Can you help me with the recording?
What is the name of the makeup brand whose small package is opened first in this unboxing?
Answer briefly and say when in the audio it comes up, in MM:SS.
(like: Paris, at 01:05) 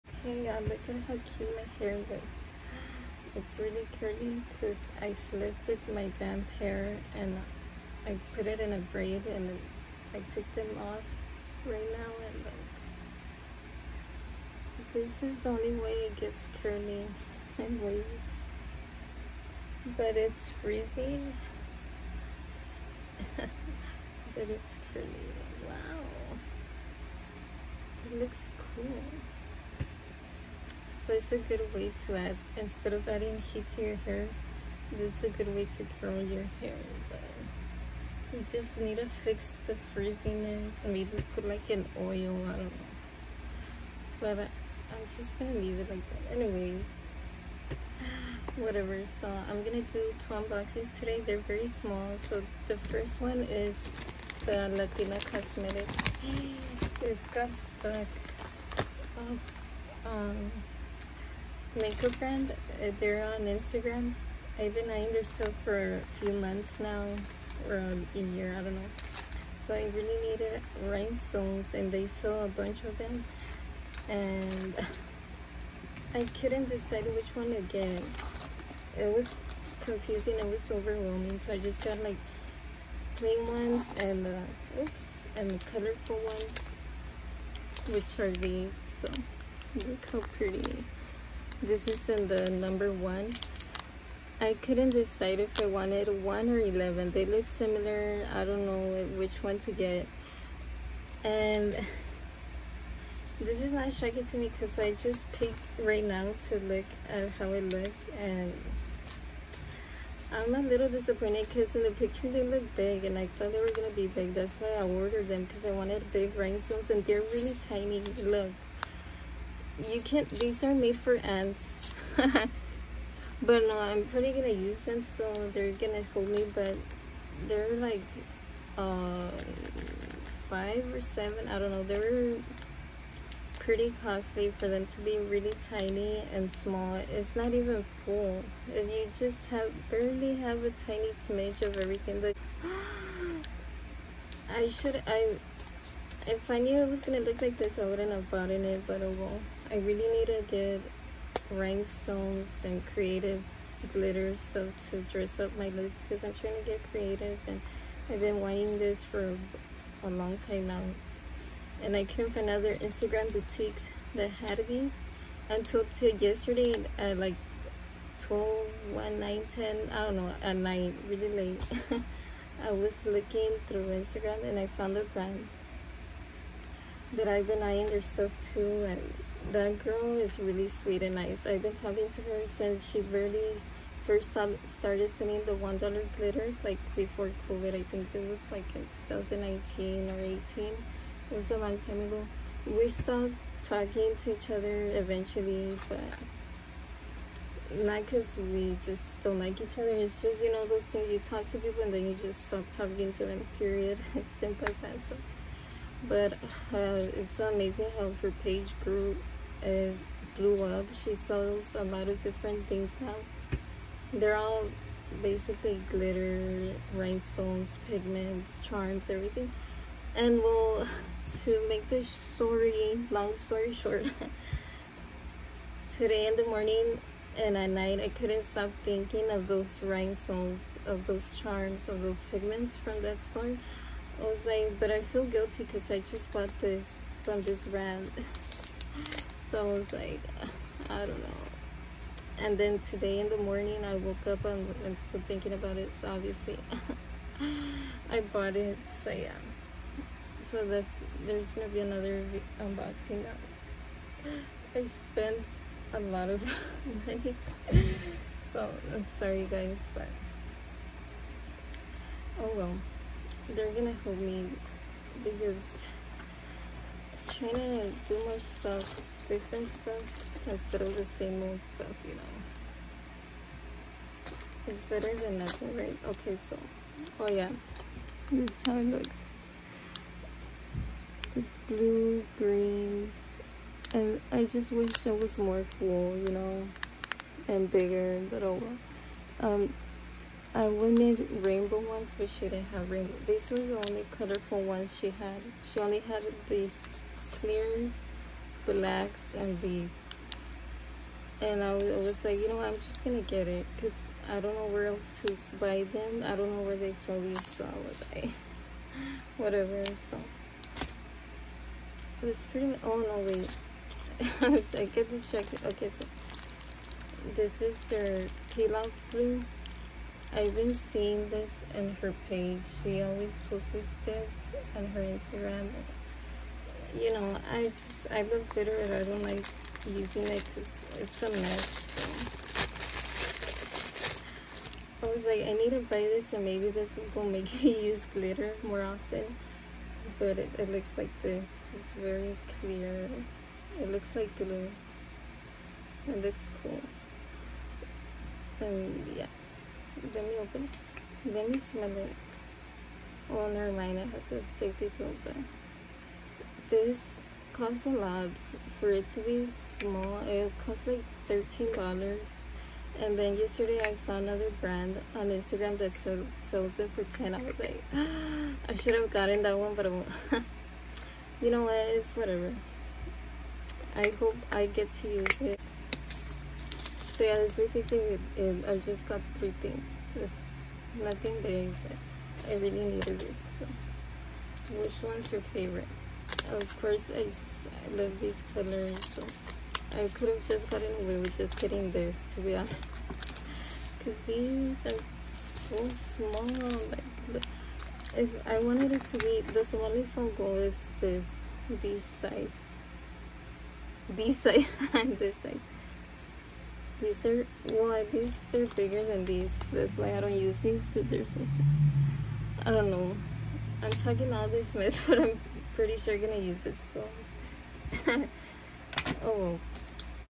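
Latina Cosmetics, at 00:54.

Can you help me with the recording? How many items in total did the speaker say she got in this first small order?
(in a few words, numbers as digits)
3.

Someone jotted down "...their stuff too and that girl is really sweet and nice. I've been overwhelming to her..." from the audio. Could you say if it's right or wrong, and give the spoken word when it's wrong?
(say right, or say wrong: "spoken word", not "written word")
wrong: "talking", not "overwhelming".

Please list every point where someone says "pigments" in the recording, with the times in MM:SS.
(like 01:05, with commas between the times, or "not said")
03:37, 03:52.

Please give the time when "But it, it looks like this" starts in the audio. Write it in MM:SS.
05:40.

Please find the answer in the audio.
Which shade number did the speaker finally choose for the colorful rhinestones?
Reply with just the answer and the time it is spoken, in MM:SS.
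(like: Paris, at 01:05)
1, at 01:32.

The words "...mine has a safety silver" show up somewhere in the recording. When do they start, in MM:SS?
05:53.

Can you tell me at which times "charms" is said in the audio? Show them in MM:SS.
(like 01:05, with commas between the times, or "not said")
03:38, 03:51.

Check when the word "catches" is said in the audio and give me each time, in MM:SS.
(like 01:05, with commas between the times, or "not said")
not said.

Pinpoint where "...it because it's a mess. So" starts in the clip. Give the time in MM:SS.
05:30.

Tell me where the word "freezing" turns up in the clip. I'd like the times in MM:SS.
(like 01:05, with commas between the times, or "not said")
00:20.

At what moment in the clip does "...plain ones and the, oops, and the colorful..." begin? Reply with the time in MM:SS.
01:23.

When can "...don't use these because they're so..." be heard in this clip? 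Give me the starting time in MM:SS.
06:50.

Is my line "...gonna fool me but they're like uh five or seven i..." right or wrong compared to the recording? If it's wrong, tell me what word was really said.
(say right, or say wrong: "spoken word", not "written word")
right.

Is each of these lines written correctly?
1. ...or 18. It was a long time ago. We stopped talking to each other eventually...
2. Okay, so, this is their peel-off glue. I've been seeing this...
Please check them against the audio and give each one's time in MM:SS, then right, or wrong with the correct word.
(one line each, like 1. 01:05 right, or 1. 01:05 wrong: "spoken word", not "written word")
1. 03:10 right
2. 05:15 right.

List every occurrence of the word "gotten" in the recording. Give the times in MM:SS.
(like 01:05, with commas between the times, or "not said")
06:09, 06:30.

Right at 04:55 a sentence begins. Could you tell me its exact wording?
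She only had these clears, blacks, and these.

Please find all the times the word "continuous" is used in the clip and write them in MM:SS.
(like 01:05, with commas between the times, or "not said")
not said.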